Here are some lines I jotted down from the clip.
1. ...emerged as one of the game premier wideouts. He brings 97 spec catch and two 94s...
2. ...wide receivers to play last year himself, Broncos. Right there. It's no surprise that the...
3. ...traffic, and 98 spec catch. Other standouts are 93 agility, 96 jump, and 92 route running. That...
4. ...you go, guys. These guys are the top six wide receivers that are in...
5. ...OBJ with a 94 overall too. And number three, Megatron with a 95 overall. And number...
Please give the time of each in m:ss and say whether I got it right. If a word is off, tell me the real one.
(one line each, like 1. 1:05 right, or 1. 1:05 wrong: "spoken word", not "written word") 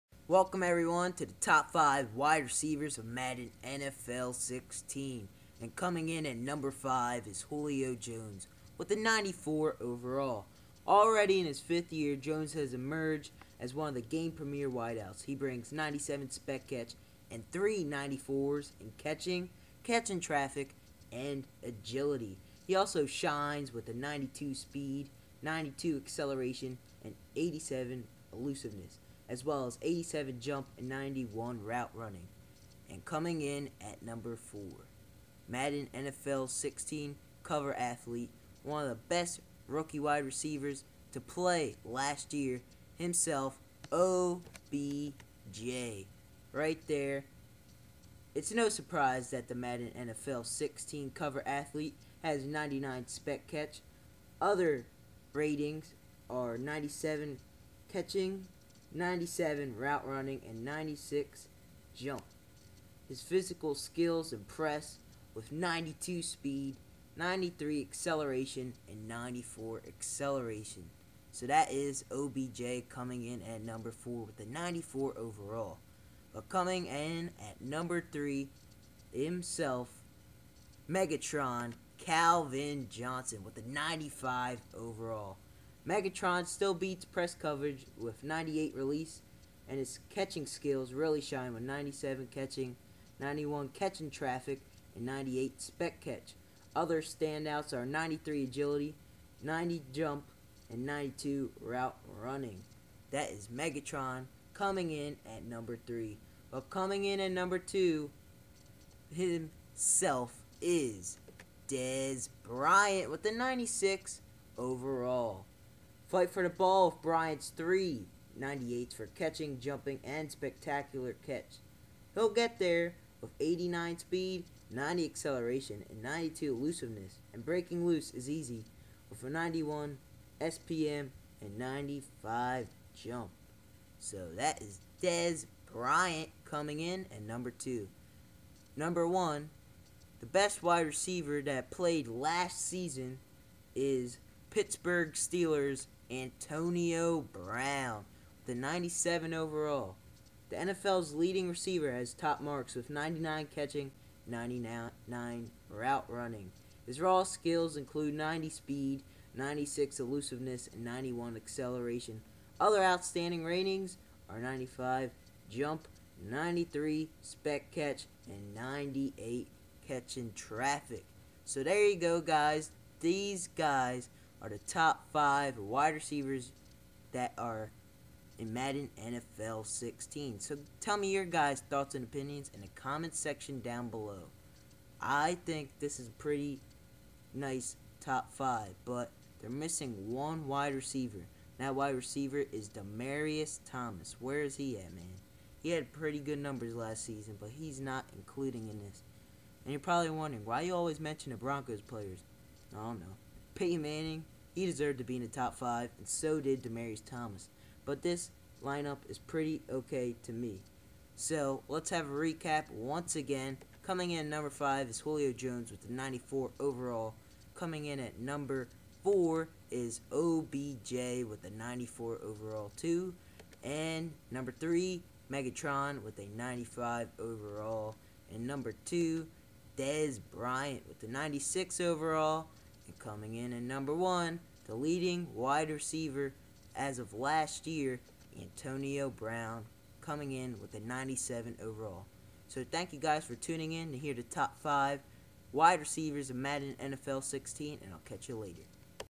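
1. 0:12 wrong: "three", not "two"
2. 0:40 wrong: "OBJ", not "Broncos"
3. 1:34 wrong: "90", not "96"
4. 2:51 wrong: "five", not "six"
5. 3:40 right.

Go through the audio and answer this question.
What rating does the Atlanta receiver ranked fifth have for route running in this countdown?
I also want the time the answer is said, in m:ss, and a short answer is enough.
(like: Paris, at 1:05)
91, at 0:30.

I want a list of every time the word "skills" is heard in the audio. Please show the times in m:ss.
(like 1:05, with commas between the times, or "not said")
1:03, 1:30, 2:37.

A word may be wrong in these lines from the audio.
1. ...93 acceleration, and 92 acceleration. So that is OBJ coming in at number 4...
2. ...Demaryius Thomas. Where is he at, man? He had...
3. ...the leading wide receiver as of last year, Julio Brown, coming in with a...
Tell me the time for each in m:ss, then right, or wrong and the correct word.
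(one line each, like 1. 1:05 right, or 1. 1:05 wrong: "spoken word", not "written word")
1. 1:07 wrong: "94", not "92"
2. 3:12 right
3. 3:54 wrong: "Antonio", not "Julio".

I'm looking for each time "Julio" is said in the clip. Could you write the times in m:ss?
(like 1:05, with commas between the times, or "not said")
0:07, 3:34.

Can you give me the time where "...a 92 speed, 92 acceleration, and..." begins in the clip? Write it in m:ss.
0:23.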